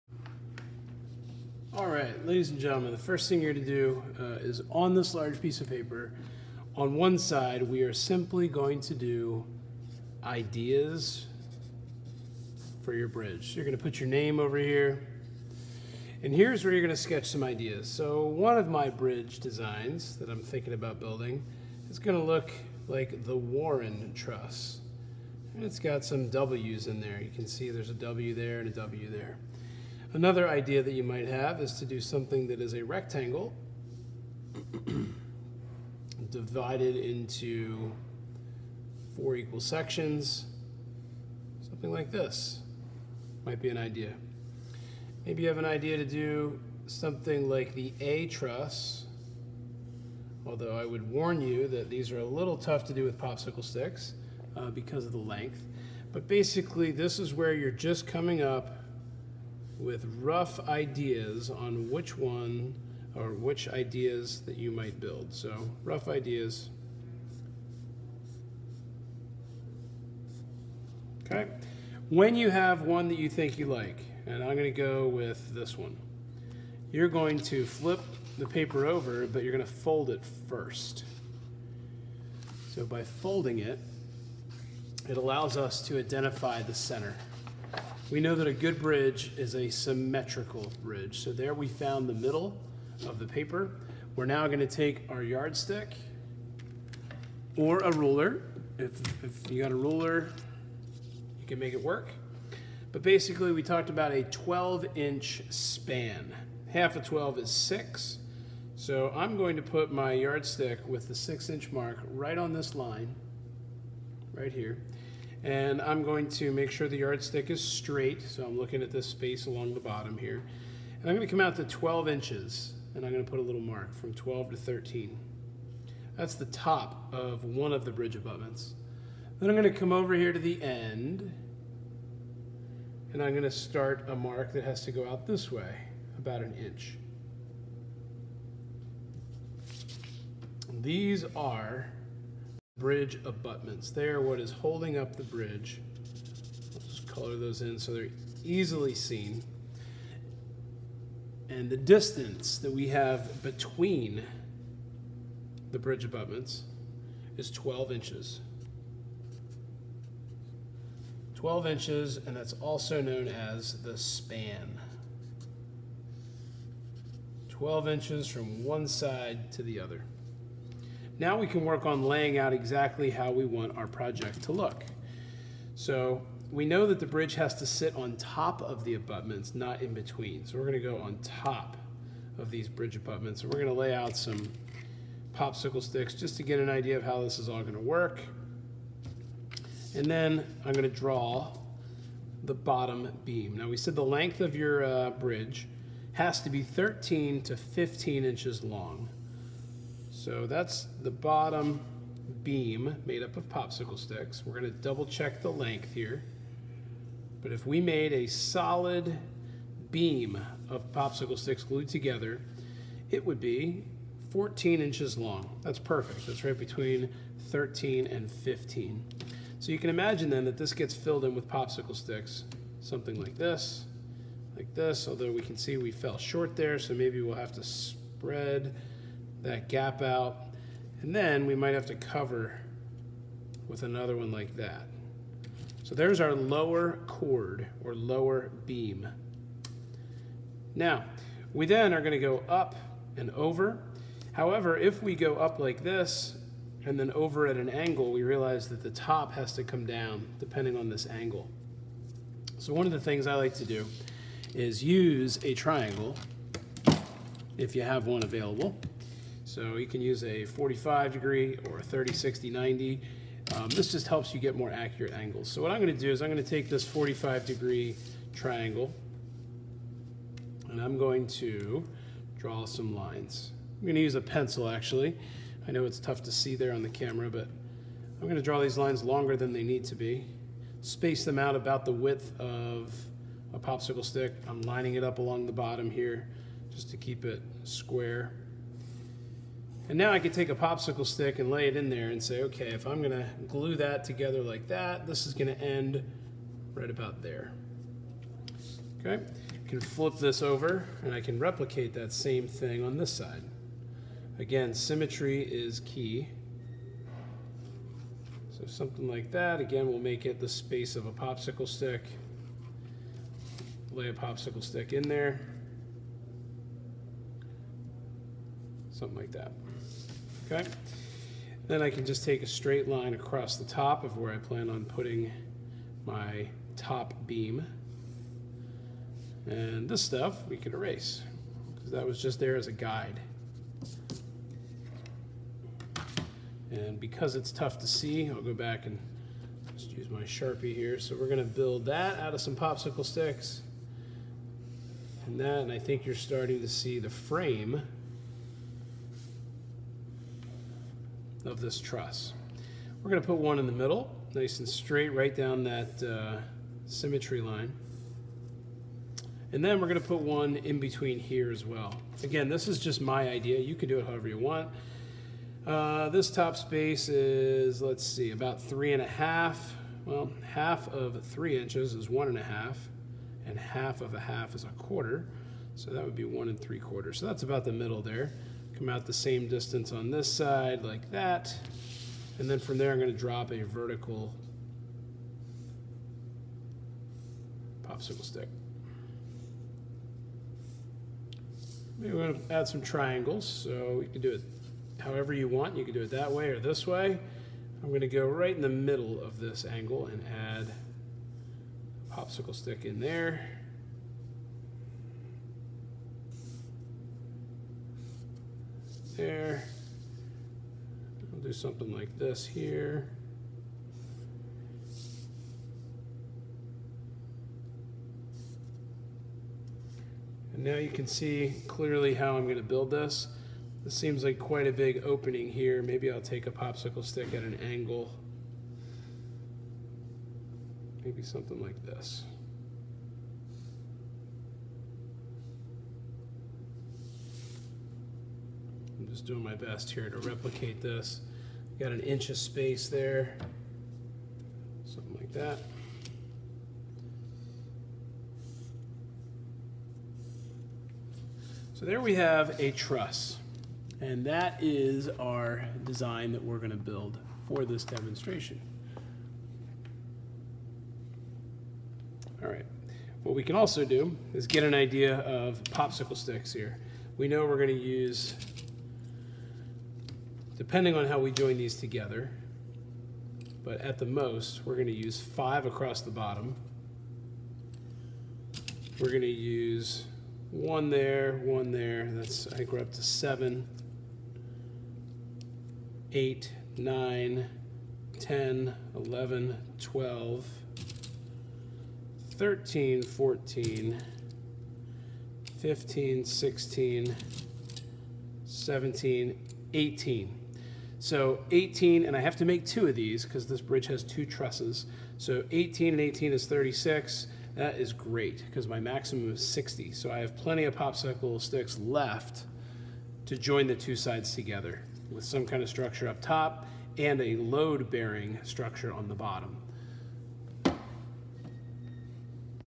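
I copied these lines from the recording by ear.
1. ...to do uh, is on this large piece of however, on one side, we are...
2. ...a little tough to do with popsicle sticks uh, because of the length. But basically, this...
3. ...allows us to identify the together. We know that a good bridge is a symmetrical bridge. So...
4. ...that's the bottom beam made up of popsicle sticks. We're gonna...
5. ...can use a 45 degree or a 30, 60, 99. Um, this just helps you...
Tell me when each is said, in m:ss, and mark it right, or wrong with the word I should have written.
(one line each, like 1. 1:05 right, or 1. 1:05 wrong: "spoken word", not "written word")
1. 0:03 wrong: "paper", not "however"
2. 0:52 right
3. 1:25 wrong: "center", not "together"
4. 3:20 right
5. 4:19 wrong: "90", not "99".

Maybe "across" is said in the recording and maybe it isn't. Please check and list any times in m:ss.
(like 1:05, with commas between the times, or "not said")
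5:23, 7:55.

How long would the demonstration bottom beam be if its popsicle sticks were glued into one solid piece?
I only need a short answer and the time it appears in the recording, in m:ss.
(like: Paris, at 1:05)
14 inches, at 3:34.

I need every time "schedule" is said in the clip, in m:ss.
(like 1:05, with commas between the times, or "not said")
not said.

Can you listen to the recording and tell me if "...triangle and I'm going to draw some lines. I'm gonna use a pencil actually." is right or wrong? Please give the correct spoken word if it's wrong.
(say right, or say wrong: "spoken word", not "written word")
right.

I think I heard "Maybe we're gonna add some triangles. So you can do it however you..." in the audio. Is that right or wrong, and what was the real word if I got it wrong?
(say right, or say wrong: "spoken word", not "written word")
right.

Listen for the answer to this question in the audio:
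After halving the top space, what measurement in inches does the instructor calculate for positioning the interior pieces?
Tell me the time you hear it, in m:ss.
6:16.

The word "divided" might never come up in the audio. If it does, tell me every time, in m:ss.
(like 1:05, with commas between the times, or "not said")
0:36.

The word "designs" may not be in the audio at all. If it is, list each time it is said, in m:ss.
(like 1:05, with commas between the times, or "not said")
0:19, 7:35.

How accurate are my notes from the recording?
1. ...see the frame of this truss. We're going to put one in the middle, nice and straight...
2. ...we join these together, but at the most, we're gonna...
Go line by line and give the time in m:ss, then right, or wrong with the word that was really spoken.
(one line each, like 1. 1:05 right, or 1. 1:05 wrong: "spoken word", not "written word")
1. 5:46 right
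2. 7:51 right.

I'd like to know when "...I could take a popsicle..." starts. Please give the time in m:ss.
4:50.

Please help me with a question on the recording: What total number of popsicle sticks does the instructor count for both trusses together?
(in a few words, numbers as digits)
36.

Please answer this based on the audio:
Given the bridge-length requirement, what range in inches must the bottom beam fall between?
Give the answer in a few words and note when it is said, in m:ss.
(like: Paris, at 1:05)
13 to 15 inches, at 3:16.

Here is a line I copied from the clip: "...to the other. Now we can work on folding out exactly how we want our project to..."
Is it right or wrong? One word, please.
wrong.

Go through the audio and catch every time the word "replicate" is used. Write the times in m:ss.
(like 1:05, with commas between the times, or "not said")
5:01, 7:20.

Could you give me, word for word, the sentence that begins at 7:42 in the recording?
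All right, what we can also do is get an idea of popsicle sticks here.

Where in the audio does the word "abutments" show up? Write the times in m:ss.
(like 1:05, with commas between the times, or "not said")
2:08, 2:23, 2:36, 2:58, 3:02.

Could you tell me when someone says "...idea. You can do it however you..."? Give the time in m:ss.
6:03.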